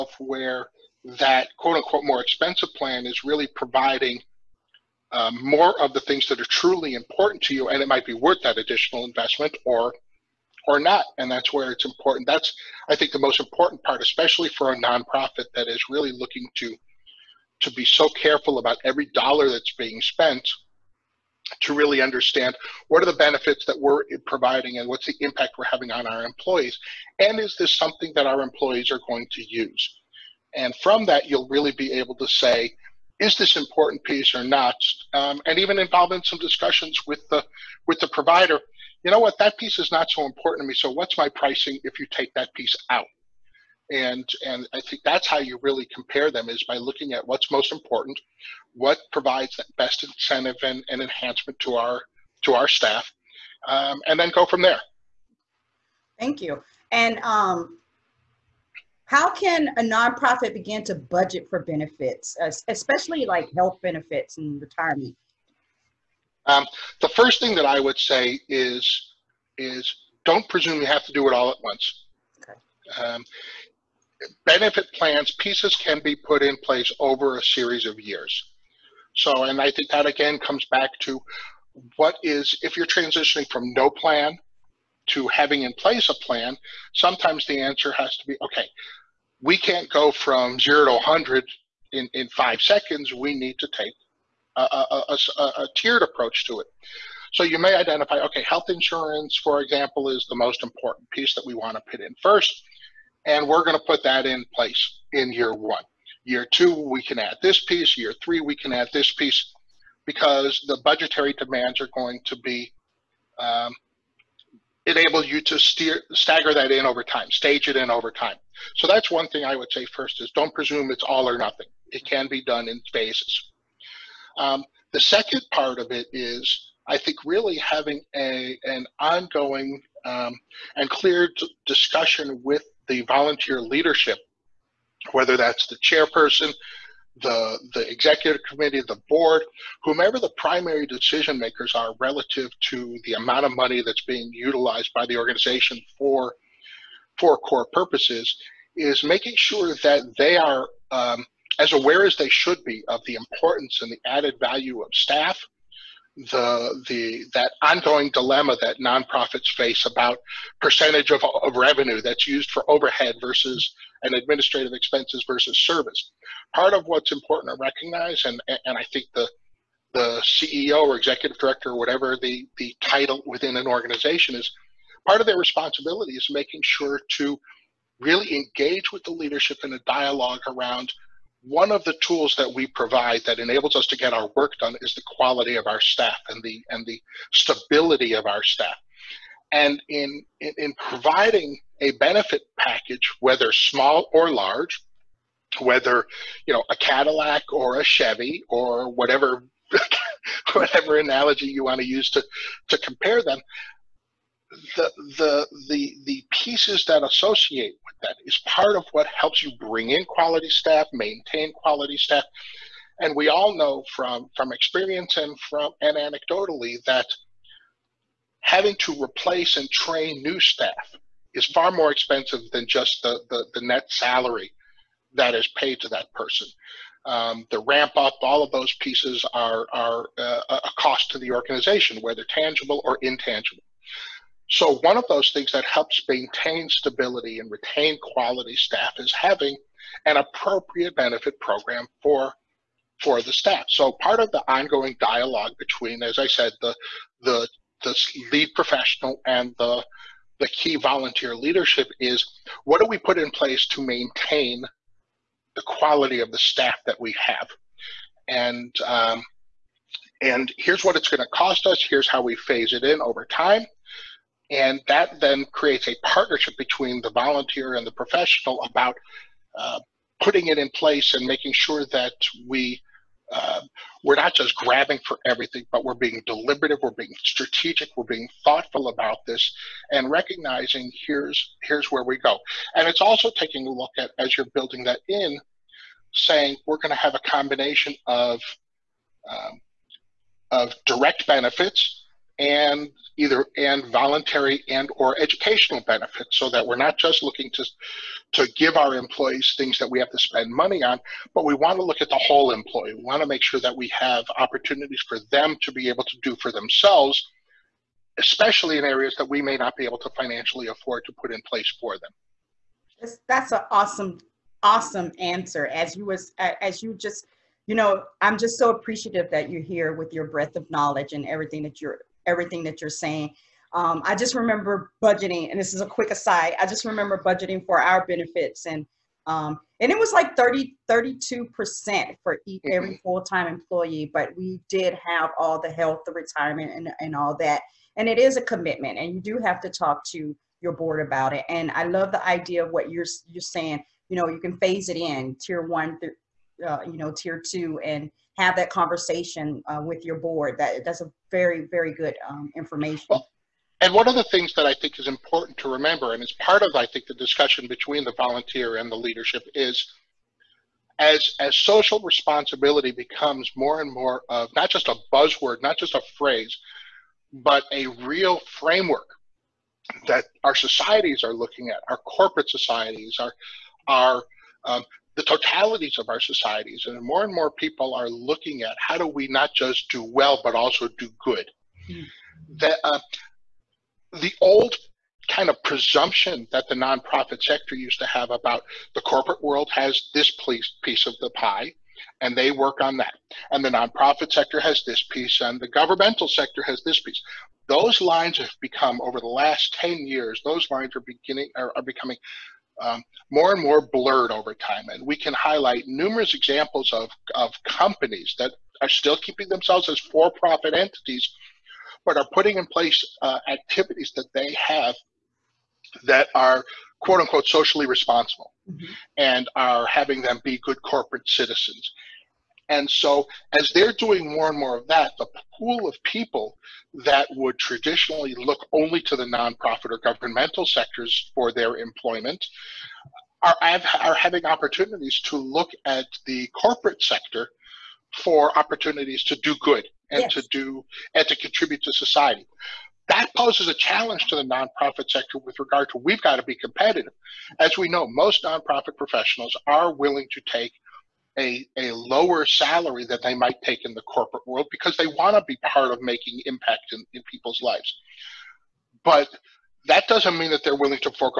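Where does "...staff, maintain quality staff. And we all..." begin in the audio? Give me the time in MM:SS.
03:30.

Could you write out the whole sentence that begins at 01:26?
Sometimes the answer has to be okay.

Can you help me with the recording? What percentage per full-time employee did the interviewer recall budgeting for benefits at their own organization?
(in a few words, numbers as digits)
32 percent.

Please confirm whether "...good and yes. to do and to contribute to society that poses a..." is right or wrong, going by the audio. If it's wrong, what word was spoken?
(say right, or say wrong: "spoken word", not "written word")
right.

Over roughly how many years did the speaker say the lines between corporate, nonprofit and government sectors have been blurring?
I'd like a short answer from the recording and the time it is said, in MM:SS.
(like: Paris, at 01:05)
10 years, at 06:39.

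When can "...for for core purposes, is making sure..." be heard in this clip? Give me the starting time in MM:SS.
02:25.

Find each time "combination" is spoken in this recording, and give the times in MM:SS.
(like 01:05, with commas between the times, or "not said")
04:47.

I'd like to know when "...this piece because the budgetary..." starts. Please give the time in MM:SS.
01:48.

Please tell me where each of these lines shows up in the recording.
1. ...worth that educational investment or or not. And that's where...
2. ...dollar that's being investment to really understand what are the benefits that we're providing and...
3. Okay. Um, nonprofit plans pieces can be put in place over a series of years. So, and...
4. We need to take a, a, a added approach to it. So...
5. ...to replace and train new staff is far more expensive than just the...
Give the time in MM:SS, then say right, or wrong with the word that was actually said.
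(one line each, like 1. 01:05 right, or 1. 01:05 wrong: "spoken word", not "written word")
1. 00:08 wrong: "additional", not "educational"
2. 00:19 wrong: "spent", not "investment"
3. 01:12 wrong: "benefit", not "nonprofit"
4. 01:33 wrong: "tiered", not "added"
5. 03:38 right.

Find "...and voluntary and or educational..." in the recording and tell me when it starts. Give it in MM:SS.
04:53.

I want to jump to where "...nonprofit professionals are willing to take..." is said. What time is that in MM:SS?
07:28.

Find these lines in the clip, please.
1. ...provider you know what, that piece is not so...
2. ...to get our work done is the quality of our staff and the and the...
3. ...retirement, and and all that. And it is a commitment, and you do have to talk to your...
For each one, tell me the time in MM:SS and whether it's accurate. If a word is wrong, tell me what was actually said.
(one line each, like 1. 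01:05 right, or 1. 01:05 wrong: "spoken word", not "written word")
1. 00:38 right
2. 03:03 right
3. 05:36 right.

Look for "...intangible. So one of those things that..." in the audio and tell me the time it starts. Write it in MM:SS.
03:53.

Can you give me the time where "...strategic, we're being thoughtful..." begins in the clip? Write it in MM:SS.
04:37.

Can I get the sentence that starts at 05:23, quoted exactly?
Um, I just remember budgeting, and this is a quick aside.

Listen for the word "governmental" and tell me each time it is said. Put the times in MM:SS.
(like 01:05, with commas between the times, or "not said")
06:35, 07:10.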